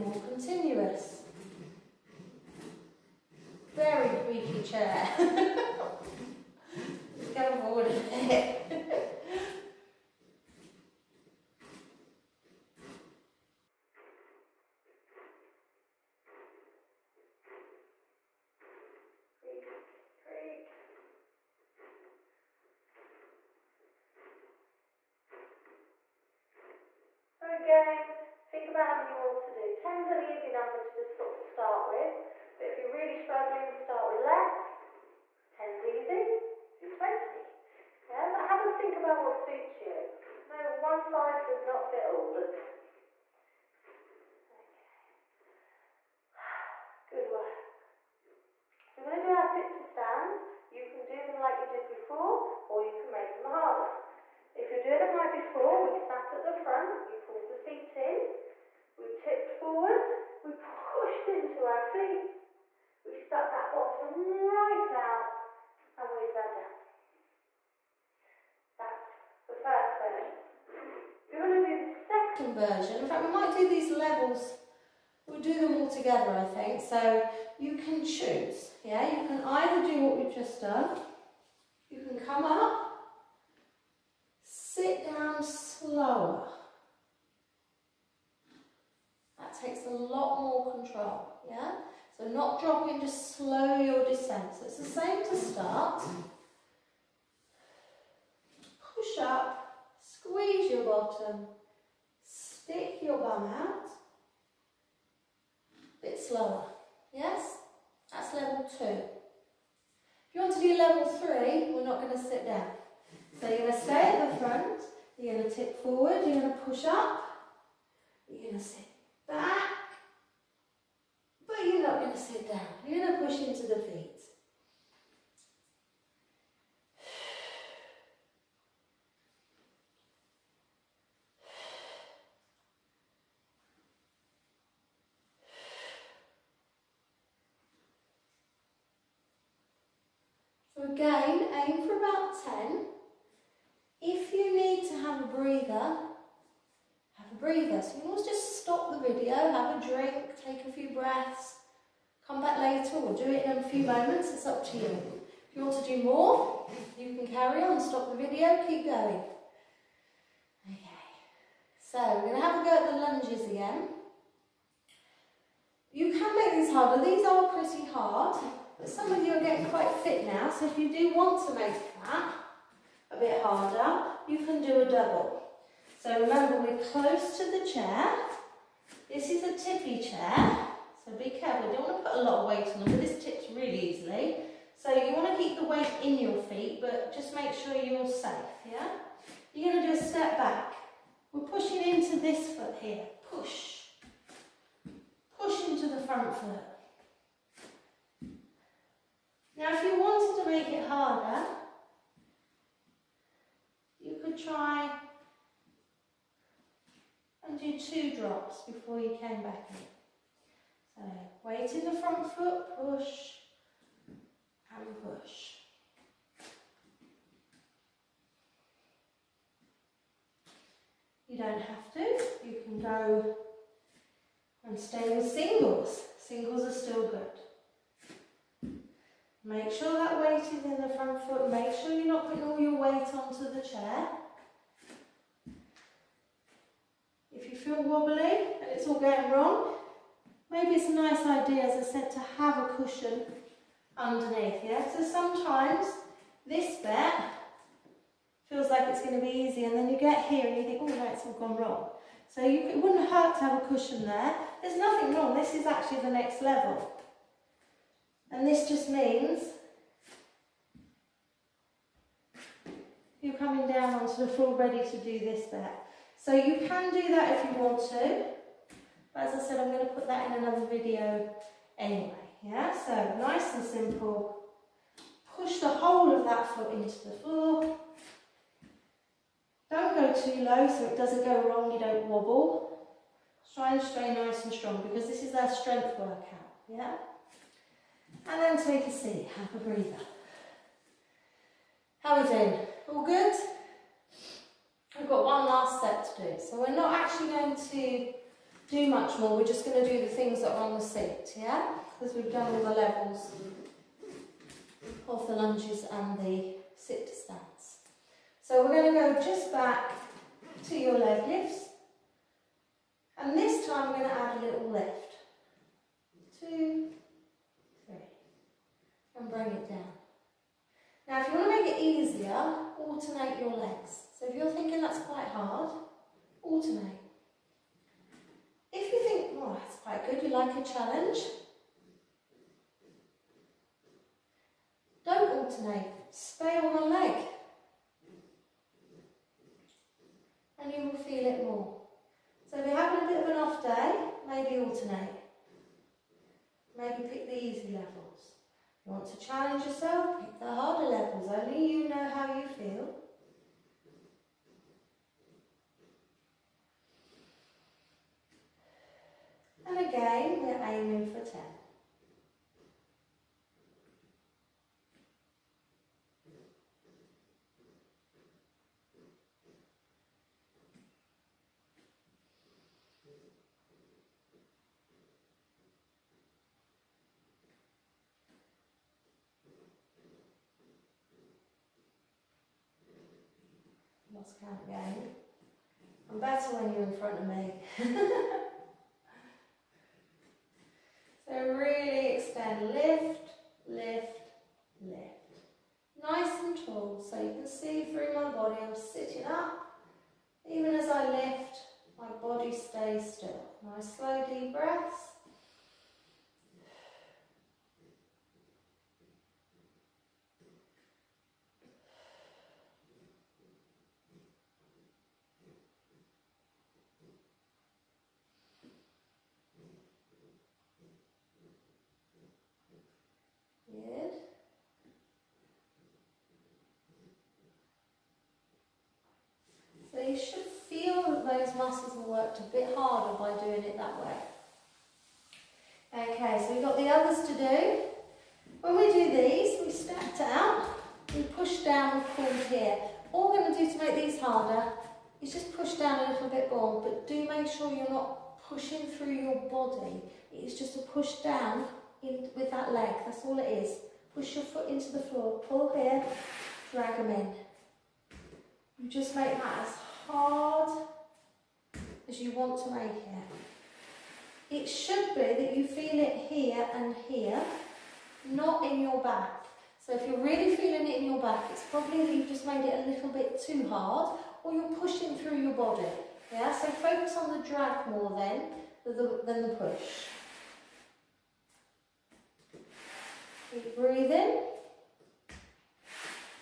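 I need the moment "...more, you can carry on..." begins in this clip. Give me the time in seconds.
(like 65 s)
156 s.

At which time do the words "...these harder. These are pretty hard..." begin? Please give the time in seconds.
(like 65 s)
166 s.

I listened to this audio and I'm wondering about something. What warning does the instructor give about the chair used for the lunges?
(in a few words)
tippy chair.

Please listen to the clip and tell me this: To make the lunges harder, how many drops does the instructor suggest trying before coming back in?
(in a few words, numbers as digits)
2.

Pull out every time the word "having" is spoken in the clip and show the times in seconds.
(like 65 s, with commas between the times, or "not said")
342 s.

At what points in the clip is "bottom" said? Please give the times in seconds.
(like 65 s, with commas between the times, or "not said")
63 s, 100 s.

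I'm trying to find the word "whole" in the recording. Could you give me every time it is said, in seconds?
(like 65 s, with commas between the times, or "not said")
275 s.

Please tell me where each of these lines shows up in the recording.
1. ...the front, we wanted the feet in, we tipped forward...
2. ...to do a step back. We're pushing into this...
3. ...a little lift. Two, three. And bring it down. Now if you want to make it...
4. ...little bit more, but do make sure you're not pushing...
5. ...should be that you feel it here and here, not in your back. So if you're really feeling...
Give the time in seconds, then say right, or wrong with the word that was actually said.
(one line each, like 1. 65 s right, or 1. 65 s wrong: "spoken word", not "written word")
1. 56 s wrong: "pulled", not "wanted"
2. 189 s right
3. 314 s right
4. 446 s right
5. 464 s right.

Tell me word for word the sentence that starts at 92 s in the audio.
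So not dropping, just slow your descent.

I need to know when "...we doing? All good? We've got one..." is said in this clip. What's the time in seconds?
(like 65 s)
292 s.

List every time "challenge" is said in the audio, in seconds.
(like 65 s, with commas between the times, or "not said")
330 s, 349 s.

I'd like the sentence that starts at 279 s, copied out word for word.
Don't go too low so it doesn't go wrong, you don't wobble.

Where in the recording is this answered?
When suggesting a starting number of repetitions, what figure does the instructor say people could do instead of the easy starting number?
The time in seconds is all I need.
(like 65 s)
36 s.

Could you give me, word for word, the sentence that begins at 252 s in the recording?
So you, it wouldn't hurt to have a cushion there.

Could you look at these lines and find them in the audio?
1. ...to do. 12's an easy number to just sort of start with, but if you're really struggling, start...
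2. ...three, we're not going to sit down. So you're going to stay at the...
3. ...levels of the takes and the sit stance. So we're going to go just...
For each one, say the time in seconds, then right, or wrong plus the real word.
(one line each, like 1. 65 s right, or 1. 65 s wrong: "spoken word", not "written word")
1. 29 s wrong: "10", not "12"
2. 111 s right
3. 302 s wrong: "lunges", not "takes".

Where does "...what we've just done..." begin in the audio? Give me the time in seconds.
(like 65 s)
80 s.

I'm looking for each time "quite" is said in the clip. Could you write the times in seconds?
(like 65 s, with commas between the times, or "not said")
169 s, 324 s, 329 s.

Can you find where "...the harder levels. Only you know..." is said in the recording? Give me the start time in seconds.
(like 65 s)
350 s.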